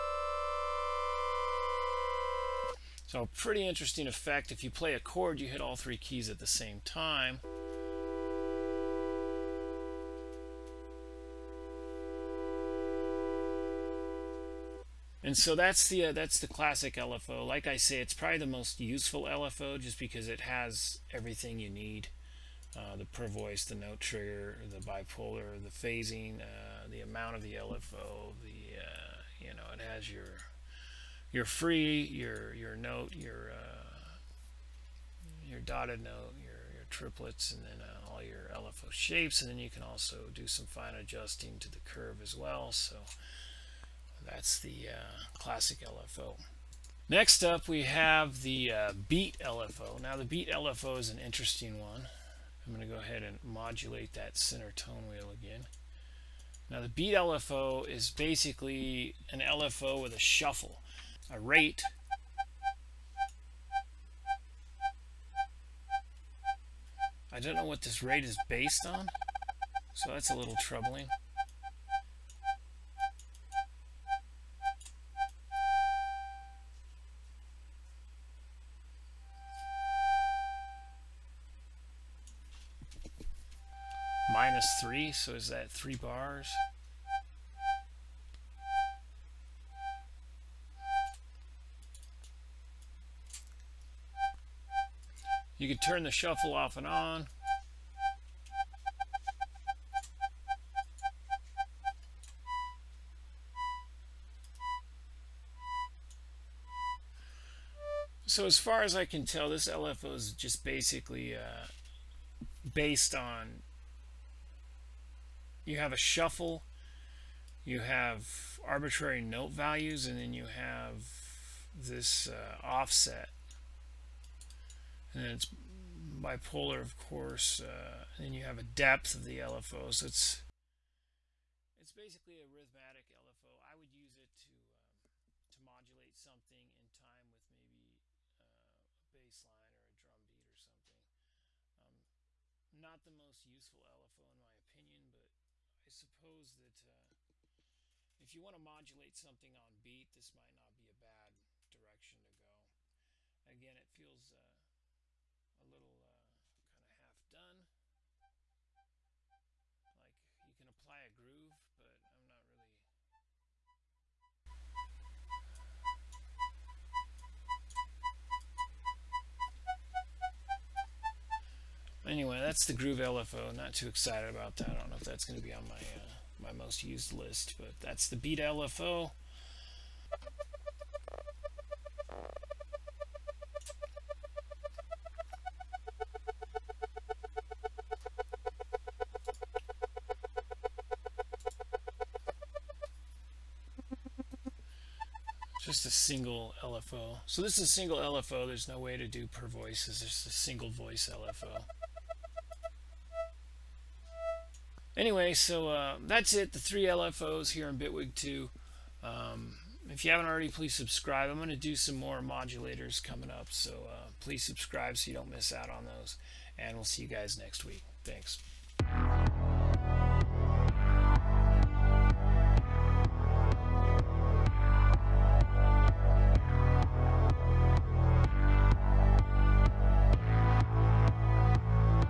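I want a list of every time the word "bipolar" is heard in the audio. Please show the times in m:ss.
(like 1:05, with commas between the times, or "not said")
0:24, 2:06.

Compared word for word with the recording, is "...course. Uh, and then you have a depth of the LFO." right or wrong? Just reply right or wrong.
right.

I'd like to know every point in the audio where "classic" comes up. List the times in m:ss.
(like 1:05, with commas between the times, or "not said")
0:16, 0:45.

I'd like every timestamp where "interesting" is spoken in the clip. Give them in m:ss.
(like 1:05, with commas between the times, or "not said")
0:03, 0:51.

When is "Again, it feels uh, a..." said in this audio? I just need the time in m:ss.
2:33.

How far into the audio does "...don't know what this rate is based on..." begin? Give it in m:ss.
1:07.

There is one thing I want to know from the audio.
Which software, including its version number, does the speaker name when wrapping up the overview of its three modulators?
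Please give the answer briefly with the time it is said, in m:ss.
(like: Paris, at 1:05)
Bitwig 2, at 3:27.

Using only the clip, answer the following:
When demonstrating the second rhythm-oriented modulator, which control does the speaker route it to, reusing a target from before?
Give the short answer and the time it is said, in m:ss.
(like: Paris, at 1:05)
center tone wheel, at 0:54.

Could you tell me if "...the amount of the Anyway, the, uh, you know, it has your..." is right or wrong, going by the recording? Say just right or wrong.
wrong.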